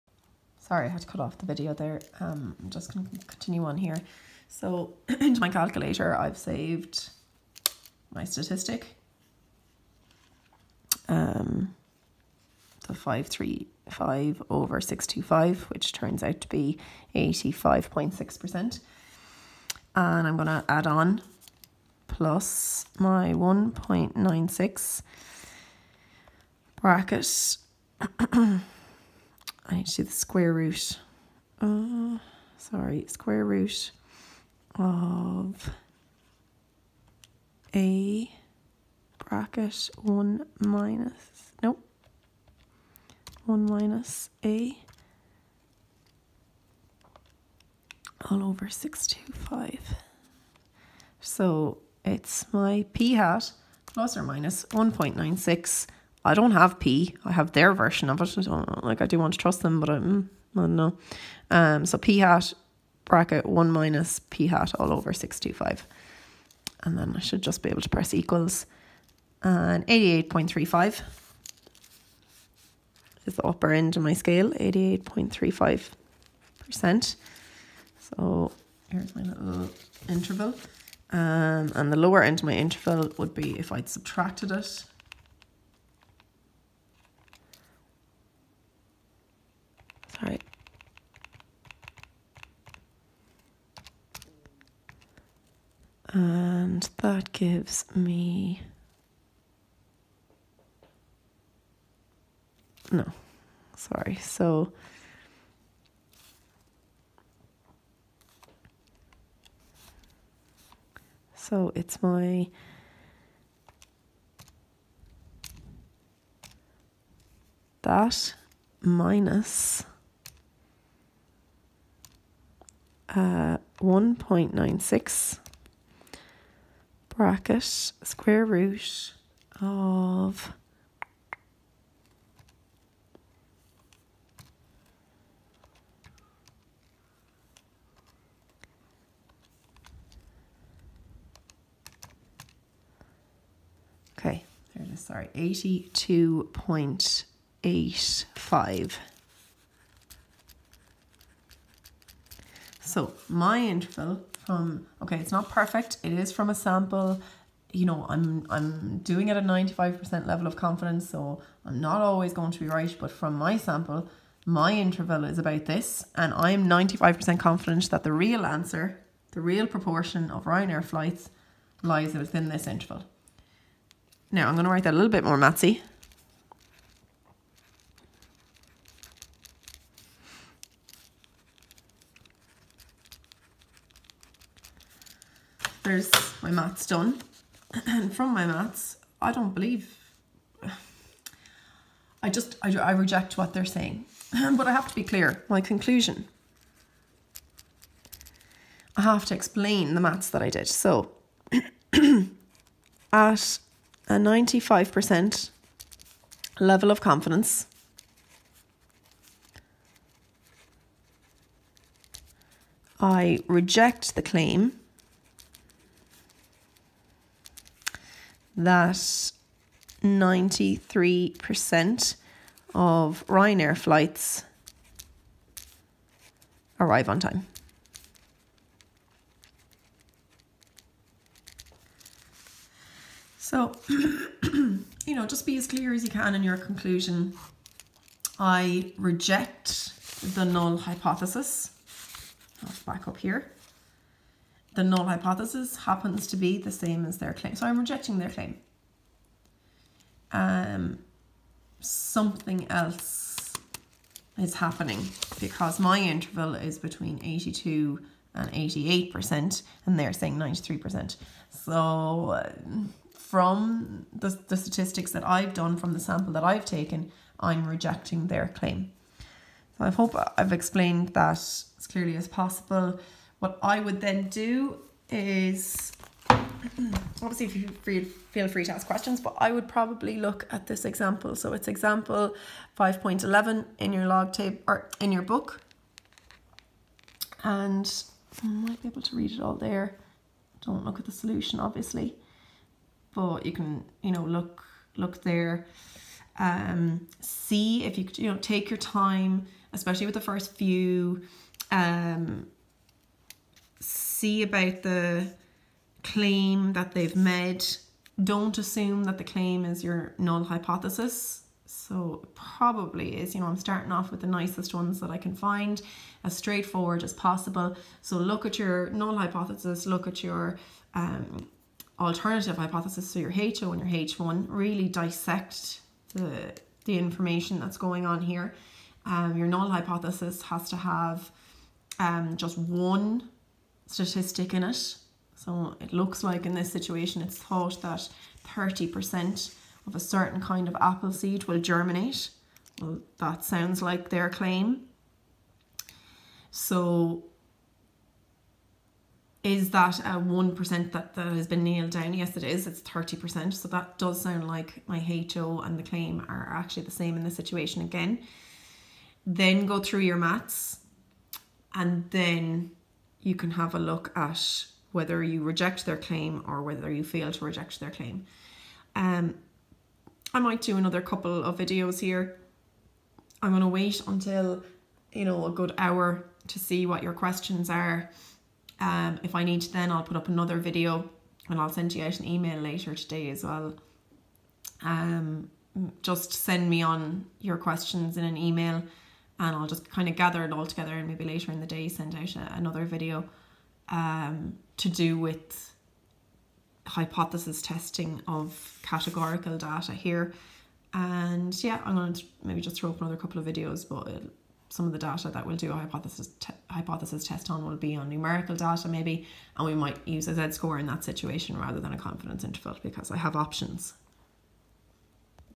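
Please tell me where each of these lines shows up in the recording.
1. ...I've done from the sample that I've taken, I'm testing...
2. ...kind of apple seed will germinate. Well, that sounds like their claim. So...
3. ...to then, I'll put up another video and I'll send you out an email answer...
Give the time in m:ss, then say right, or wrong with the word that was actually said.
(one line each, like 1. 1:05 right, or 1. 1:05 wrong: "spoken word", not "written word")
1. 4:25 wrong: "rejecting", not "testing"
2. 5:40 right
3. 6:19 wrong: "later", not "answer".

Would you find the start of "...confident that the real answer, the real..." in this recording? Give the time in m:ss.
2:47.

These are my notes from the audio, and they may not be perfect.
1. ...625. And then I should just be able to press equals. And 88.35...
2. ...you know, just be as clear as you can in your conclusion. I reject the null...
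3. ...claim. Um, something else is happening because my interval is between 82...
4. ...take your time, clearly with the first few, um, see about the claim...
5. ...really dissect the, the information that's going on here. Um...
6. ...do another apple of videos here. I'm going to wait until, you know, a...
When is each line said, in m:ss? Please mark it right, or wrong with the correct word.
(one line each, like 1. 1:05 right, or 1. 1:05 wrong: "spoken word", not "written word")
1. 1:05 right
2. 3:53 right
3. 4:08 right
4. 4:58 wrong: "especially", not "clearly"
5. 5:24 right
6. 6:10 wrong: "couple", not "apple".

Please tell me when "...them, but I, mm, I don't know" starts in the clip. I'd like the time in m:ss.
0:59.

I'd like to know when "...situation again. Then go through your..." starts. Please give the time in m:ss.
5:57.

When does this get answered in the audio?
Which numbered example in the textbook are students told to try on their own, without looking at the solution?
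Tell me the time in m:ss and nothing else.
4:42.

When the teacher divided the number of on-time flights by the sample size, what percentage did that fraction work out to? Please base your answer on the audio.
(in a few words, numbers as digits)
85.6%.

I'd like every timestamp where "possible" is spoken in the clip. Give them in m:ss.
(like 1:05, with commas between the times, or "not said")
4:32, 5:17.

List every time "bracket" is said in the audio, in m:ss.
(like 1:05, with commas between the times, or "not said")
0:26, 0:39, 1:03, 2:07.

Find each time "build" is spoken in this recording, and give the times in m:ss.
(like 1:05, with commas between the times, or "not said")
not said.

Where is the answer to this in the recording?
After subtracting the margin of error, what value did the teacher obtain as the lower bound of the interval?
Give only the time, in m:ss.
2:25.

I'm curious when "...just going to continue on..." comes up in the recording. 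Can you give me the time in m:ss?
0:02.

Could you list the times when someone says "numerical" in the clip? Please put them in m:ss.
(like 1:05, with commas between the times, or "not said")
6:48.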